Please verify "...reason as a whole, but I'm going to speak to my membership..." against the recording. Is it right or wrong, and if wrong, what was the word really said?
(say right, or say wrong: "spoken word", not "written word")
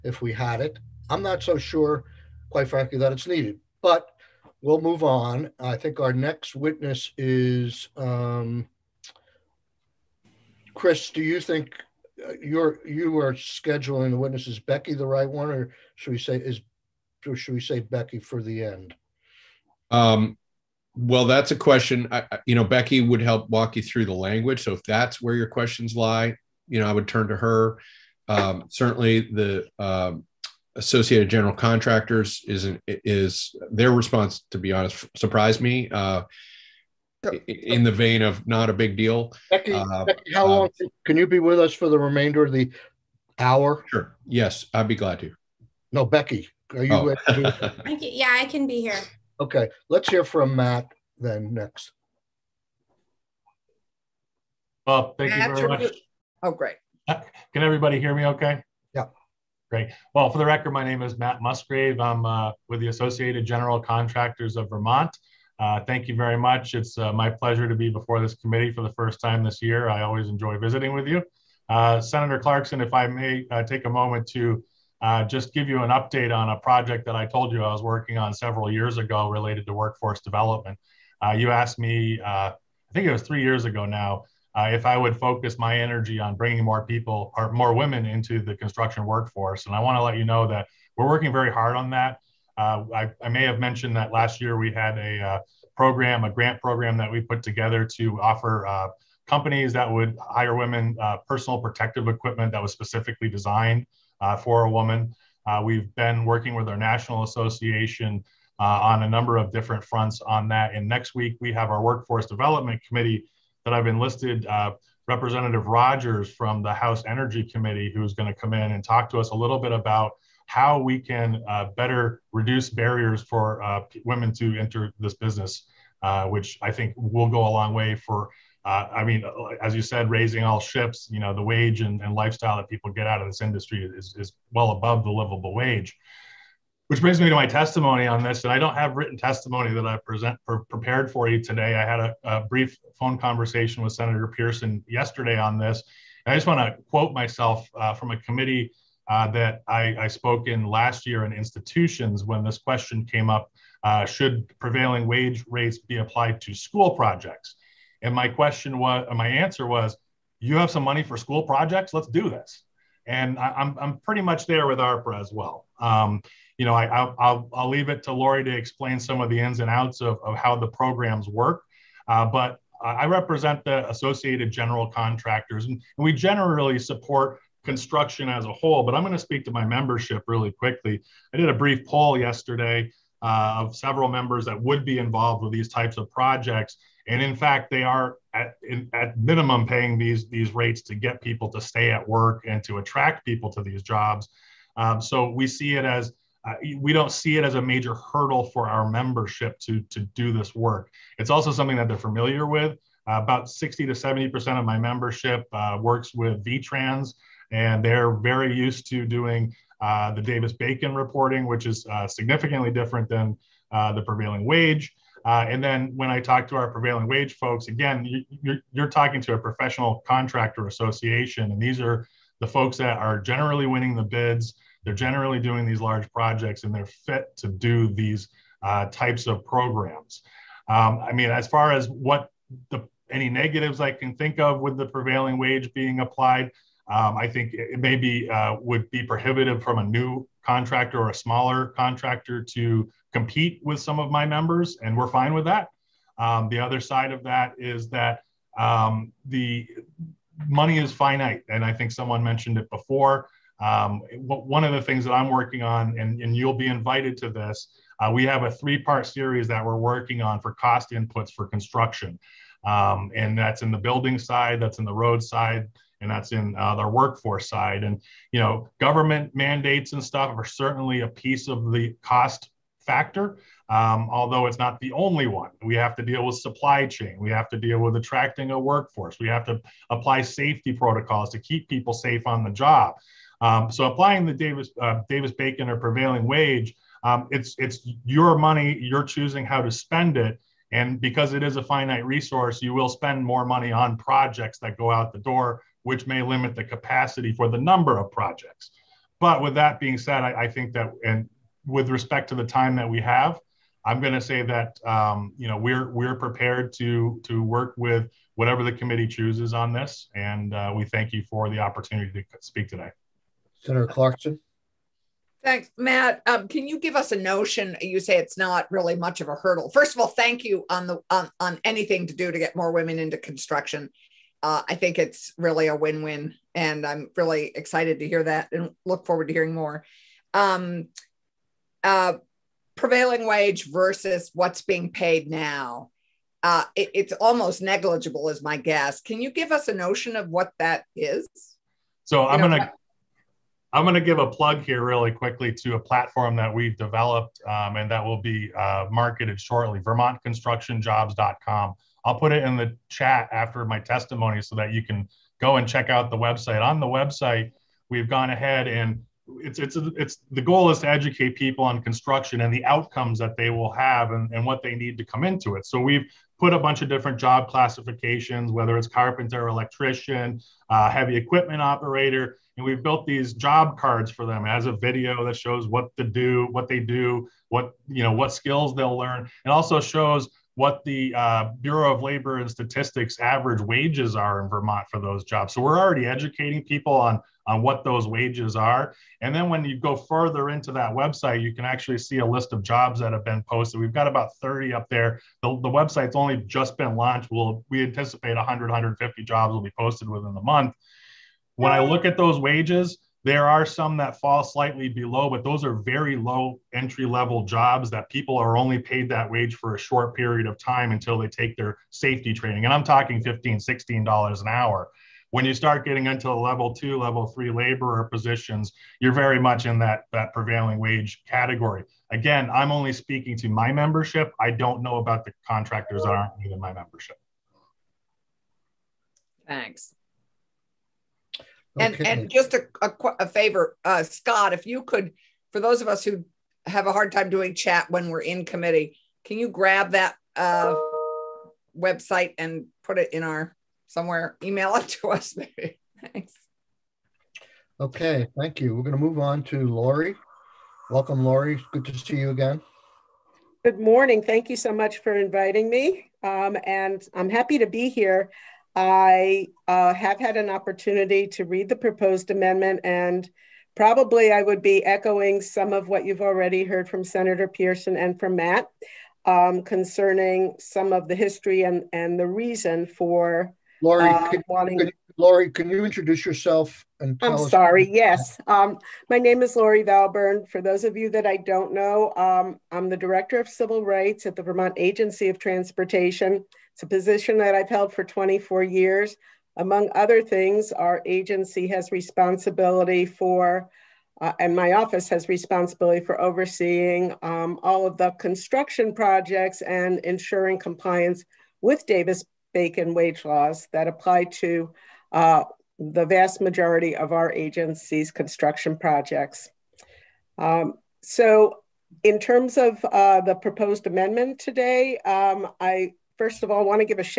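wrong: "construction", not "reason".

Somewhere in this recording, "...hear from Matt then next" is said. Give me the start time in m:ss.
0:50.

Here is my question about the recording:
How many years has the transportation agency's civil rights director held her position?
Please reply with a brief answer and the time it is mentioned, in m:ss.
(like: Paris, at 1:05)
24, at 8:08.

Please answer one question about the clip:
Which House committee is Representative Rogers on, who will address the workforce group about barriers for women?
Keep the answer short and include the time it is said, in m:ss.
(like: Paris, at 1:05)
House Energy Committee, at 1:56.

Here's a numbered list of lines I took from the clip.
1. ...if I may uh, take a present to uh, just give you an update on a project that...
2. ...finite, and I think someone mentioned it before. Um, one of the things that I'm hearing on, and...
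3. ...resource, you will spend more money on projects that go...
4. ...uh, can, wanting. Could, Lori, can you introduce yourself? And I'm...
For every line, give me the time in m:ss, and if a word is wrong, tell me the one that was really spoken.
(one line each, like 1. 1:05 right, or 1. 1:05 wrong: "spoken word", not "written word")
1. 1:12 wrong: "moment", not "present"
2. 4:10 wrong: "working", not "hearing"
3. 4:52 right
4. 7:54 right.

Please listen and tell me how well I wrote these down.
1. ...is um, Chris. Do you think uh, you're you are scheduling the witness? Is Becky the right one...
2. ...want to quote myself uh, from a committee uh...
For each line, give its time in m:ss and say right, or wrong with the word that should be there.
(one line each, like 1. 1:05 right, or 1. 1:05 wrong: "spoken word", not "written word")
1. 0:07 right
2. 2:26 right.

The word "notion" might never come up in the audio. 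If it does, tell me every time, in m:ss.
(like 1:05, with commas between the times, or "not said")
5:17, 5:39.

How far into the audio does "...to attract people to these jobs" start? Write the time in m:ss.
3:12.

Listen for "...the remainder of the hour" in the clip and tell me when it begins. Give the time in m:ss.
0:41.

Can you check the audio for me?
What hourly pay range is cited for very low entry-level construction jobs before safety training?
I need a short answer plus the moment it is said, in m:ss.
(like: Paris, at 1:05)
$15 to $16, at 6:53.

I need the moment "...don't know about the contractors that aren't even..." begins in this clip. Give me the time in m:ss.
7:04.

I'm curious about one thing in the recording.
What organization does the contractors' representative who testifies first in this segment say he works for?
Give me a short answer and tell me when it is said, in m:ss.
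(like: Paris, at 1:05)
Associated General Contractors of Vermont, at 1:02.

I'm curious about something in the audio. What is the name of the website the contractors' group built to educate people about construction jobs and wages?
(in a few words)
vermontconstructionjobs.com.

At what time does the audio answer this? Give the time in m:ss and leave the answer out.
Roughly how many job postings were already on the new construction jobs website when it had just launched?
6:34.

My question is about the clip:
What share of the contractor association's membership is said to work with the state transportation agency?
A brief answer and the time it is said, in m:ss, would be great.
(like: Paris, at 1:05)
60 to 70%, at 3:23.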